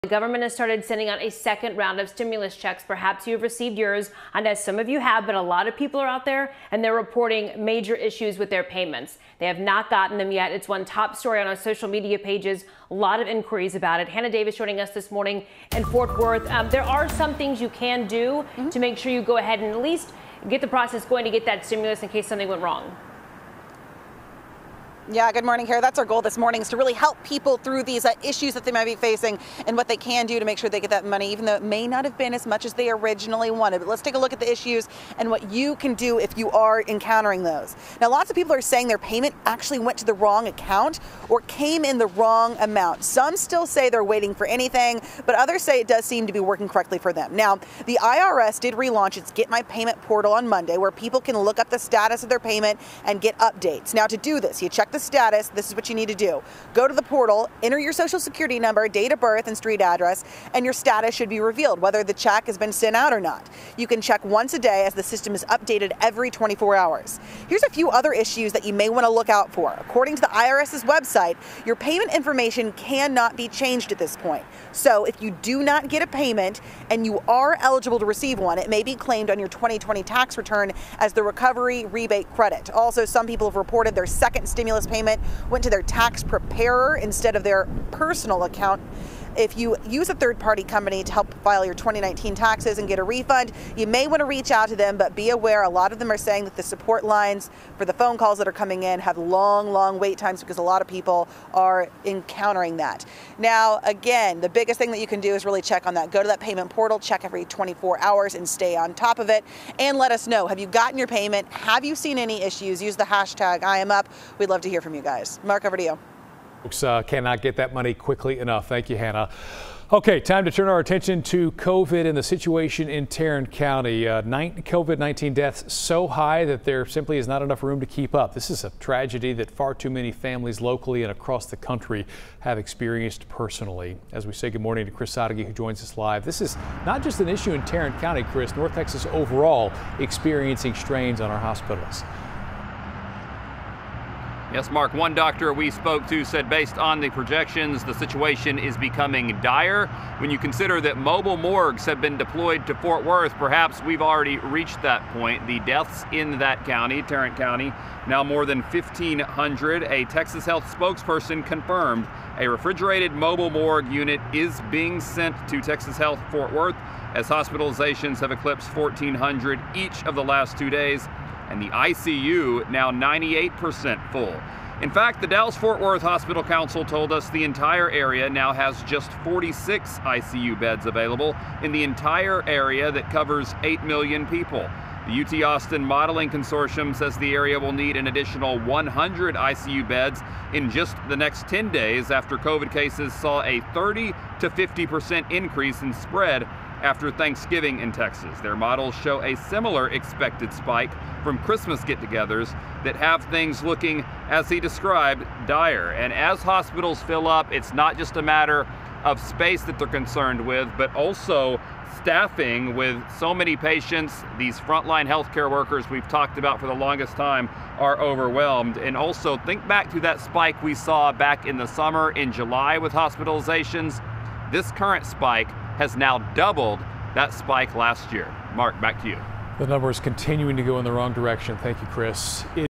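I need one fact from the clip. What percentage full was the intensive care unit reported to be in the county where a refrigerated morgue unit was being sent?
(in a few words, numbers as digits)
98%.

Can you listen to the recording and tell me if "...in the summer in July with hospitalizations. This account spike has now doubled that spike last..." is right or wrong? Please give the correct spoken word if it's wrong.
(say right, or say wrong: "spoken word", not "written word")
wrong: "current", not "account".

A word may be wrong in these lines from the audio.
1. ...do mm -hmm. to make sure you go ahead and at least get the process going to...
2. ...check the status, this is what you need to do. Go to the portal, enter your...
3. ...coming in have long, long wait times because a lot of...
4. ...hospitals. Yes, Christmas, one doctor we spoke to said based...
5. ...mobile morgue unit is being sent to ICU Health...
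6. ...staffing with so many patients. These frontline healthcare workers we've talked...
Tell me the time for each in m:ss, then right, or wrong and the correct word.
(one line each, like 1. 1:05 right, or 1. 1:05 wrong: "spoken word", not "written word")
1. 0:18 right
2. 0:54 right
3. 1:38 right
4. 2:21 wrong: "Mark", not "Christmas"
5. 2:43 wrong: "Texas", not "ICU"
6. 3:31 right.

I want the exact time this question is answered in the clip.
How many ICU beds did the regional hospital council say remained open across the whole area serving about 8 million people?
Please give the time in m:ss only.
2:59.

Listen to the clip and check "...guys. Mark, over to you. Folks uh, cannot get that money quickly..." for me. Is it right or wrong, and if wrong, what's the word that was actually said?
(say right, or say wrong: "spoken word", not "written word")
right.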